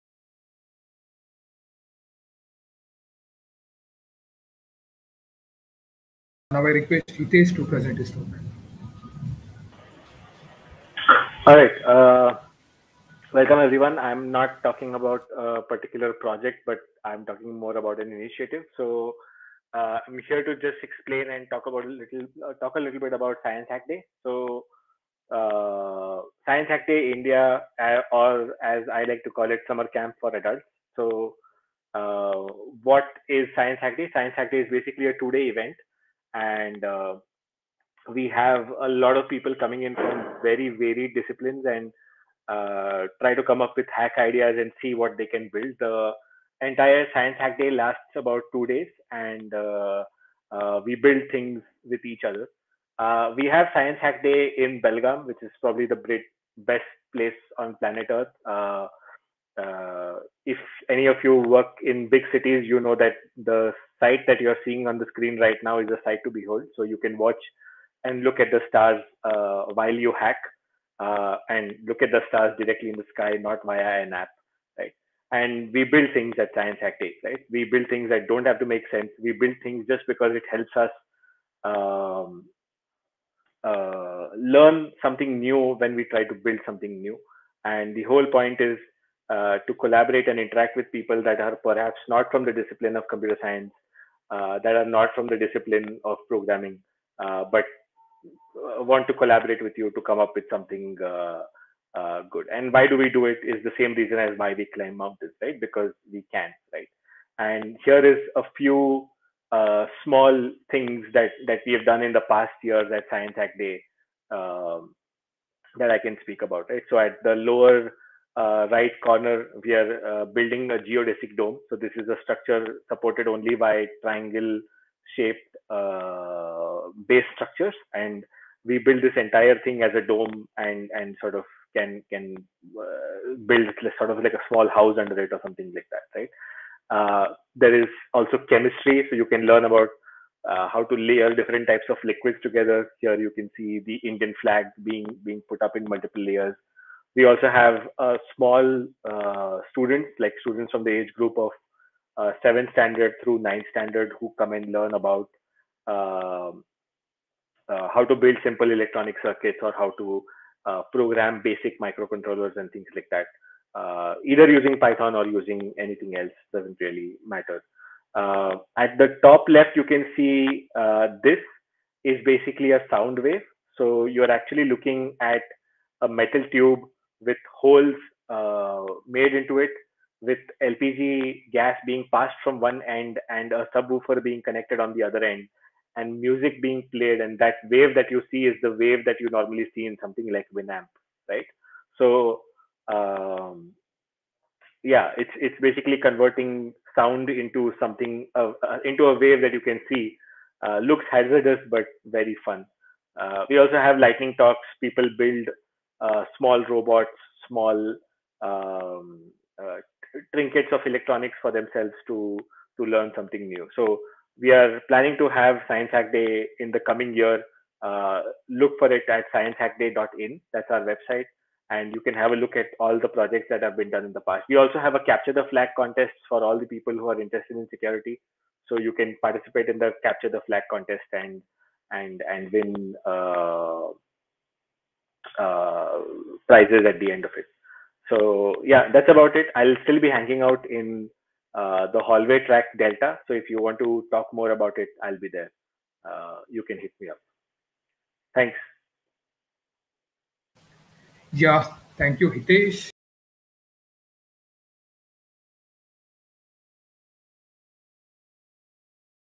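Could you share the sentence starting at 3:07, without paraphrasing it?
And that wave that you see is the wave that you normally see in something like Winamp, right?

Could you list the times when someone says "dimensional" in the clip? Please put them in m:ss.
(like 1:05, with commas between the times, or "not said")
not said.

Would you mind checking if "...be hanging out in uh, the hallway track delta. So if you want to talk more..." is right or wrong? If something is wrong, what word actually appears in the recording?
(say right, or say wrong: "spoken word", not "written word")
right.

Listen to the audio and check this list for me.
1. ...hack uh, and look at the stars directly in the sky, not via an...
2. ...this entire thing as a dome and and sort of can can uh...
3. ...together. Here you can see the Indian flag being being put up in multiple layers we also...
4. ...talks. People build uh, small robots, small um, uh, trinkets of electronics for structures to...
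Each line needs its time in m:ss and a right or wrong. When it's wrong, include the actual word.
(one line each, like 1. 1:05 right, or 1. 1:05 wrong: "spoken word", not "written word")
1. 1:10 right
2. 2:09 right
3. 2:22 right
4. 3:24 wrong: "themselves", not "structures".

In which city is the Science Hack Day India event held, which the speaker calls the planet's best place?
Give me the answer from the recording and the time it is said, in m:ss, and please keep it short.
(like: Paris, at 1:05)
Belgaum, at 0:54.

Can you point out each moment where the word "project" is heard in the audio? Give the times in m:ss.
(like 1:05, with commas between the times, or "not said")
0:16, 3:43.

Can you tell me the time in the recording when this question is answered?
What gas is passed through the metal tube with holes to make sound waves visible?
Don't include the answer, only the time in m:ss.
3:00.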